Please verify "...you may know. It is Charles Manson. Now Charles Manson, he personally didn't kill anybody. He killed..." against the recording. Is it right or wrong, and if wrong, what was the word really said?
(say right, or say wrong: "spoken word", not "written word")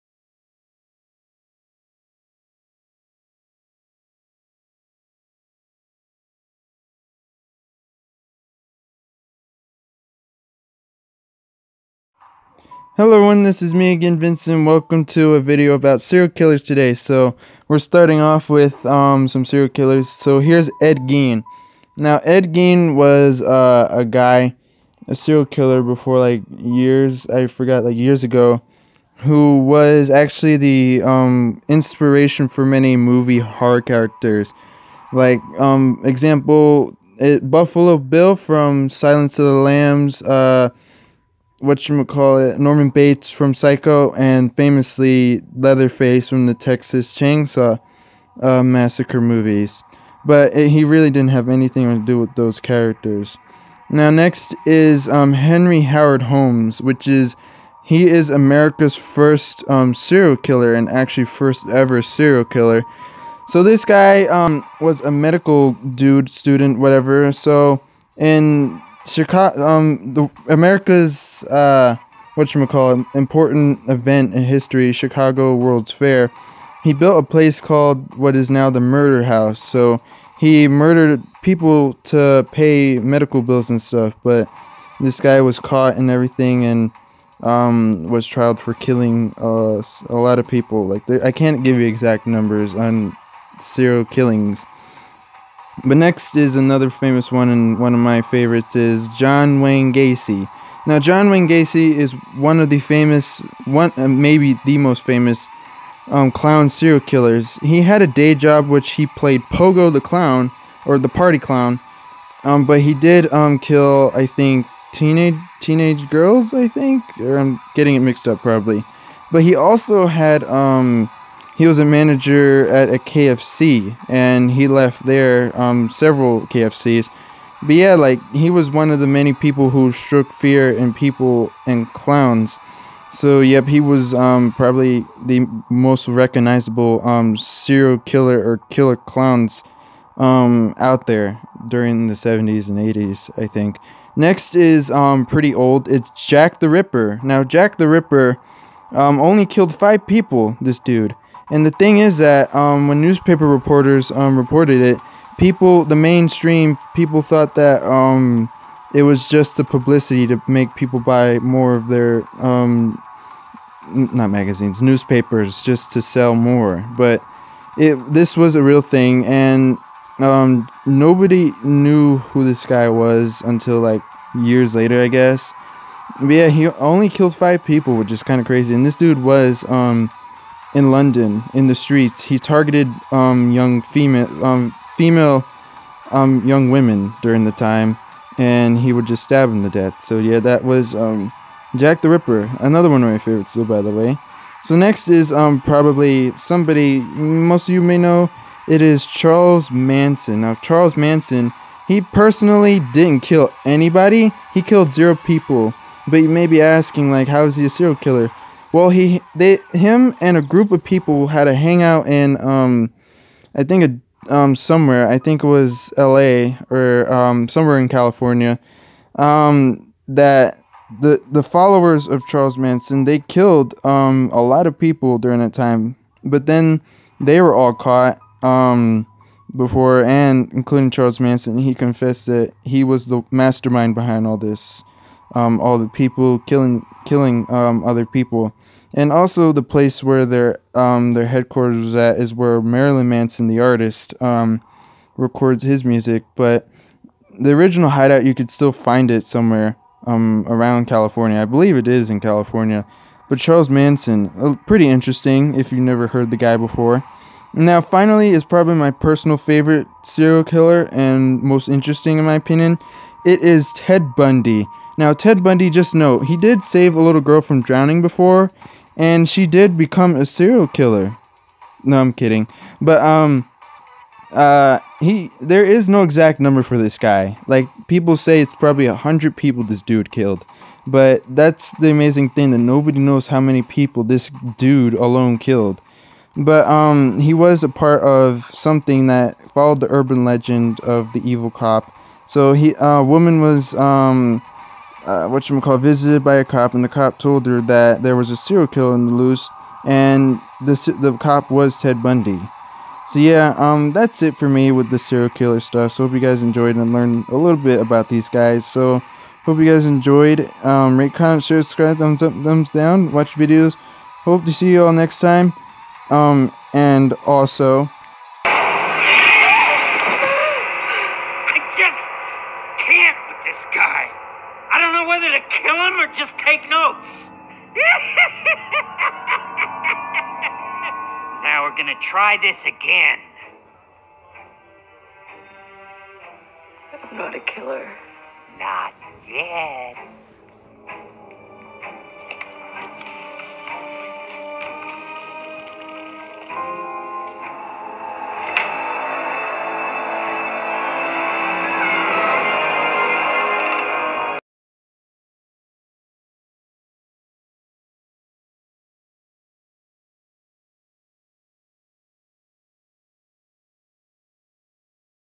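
right.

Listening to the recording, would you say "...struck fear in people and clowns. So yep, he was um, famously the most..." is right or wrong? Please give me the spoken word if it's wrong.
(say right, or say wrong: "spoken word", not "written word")
wrong: "probably", not "famously".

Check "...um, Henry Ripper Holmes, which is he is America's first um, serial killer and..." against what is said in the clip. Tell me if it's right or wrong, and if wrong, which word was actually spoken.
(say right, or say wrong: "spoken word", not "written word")
wrong: "Howard", not "Ripper".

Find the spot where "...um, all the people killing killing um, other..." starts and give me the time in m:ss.
3:55.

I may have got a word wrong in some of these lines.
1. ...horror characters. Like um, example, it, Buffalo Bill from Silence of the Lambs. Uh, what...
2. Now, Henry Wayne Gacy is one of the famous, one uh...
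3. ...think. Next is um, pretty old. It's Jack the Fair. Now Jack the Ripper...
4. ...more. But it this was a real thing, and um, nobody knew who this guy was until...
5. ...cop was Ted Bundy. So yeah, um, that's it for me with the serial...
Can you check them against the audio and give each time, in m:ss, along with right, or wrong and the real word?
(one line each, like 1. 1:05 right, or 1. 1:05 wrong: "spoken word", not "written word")
1. 0:33 right
2. 1:40 wrong: "John", not "Henry"
3. 2:23 wrong: "Ripper", not "Fair"
4. 2:46 right
5. 5:01 right.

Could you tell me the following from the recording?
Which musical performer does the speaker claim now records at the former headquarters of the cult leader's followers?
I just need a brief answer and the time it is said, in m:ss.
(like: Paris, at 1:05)
Marilyn Manson, at 4:02.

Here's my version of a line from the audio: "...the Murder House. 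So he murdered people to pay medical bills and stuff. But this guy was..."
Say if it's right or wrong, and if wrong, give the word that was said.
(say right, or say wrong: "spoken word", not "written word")
right.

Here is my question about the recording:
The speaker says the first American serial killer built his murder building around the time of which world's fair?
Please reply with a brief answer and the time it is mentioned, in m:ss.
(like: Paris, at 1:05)
Chicago World's Fair, at 1:14.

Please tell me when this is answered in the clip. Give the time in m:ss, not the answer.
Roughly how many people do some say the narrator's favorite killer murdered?
4:38.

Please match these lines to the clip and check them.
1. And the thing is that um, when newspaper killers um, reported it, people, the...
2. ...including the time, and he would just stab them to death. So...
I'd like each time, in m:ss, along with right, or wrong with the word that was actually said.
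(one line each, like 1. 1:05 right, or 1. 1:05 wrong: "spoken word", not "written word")
1. 2:31 wrong: "reporters", not "killers"
2. 3:07 wrong: "during", not "including".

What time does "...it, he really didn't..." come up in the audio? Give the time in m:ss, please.
0:50.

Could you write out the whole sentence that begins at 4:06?
But the original hideout, you could still find it somewhere um, around California.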